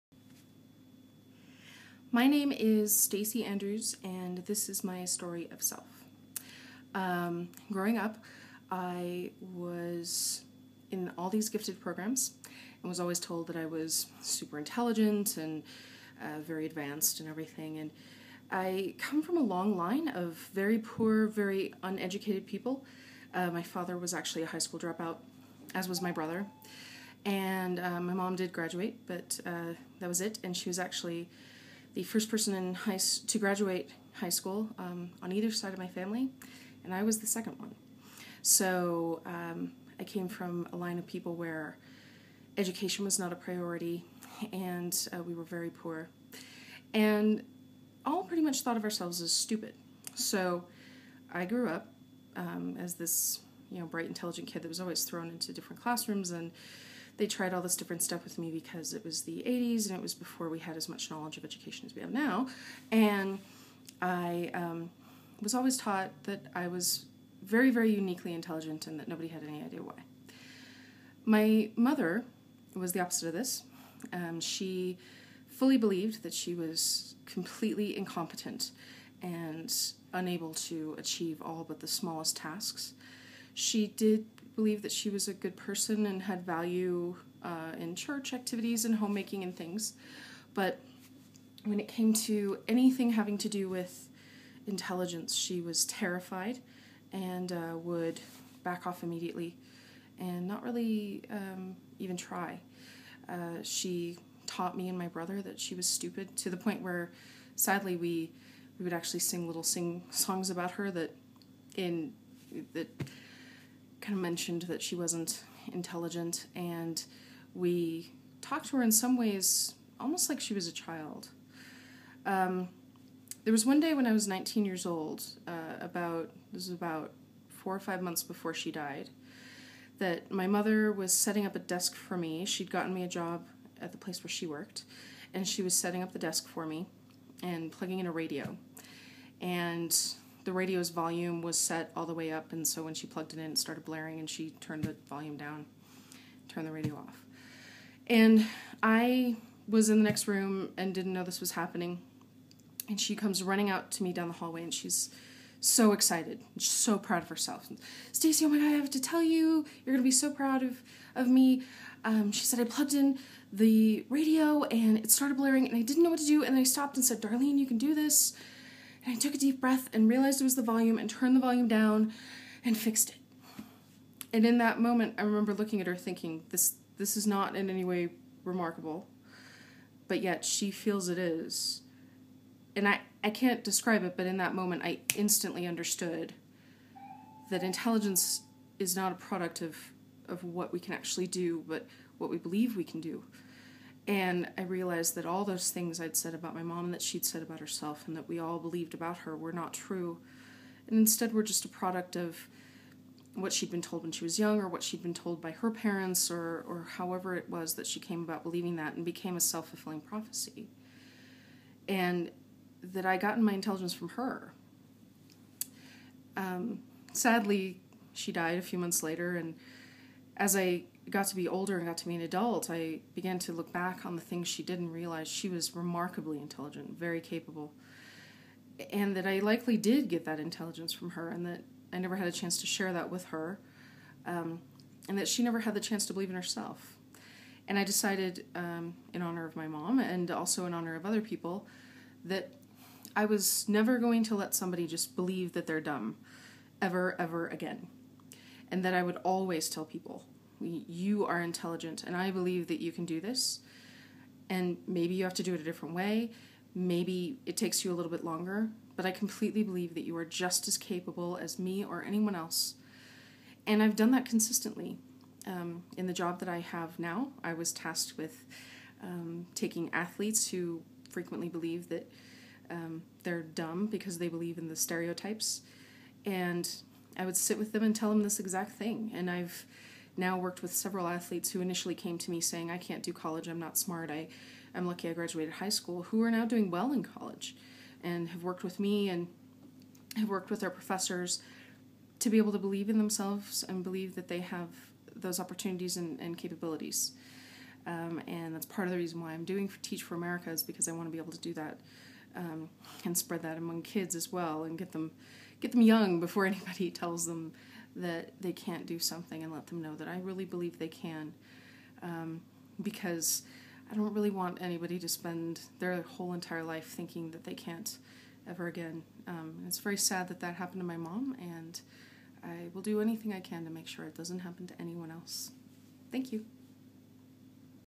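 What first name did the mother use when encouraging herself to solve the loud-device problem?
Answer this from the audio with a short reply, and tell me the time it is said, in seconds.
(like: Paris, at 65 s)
Darlene, at 167 s.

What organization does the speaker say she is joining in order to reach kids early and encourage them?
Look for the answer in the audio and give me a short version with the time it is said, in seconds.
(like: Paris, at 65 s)
Teach for America, at 299 s.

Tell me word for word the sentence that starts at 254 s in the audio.
And maybe you have to do it a different way.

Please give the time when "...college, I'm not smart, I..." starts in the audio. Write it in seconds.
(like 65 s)
283 s.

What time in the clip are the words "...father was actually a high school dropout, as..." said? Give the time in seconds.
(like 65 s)
23 s.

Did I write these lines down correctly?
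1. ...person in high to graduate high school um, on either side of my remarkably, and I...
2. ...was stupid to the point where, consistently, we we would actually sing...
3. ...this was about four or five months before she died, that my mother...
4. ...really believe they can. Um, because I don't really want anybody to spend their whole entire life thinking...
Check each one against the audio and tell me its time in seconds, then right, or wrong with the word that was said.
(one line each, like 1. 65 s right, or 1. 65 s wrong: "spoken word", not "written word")
1. 32 s wrong: "family", not "remarkably"
2. 105 s wrong: "sadly", not "consistently"
3. 126 s right
4. 310 s right.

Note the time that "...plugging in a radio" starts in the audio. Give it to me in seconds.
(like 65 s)
137 s.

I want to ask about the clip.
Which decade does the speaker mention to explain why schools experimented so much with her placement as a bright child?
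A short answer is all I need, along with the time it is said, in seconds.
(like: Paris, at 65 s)
The 80s, at 59 s.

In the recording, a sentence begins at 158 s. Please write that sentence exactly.
Stacy, oh my god, I have to tell you, you're gonna be so proud of of me.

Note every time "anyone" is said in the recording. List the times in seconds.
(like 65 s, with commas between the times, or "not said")
262 s, 324 s.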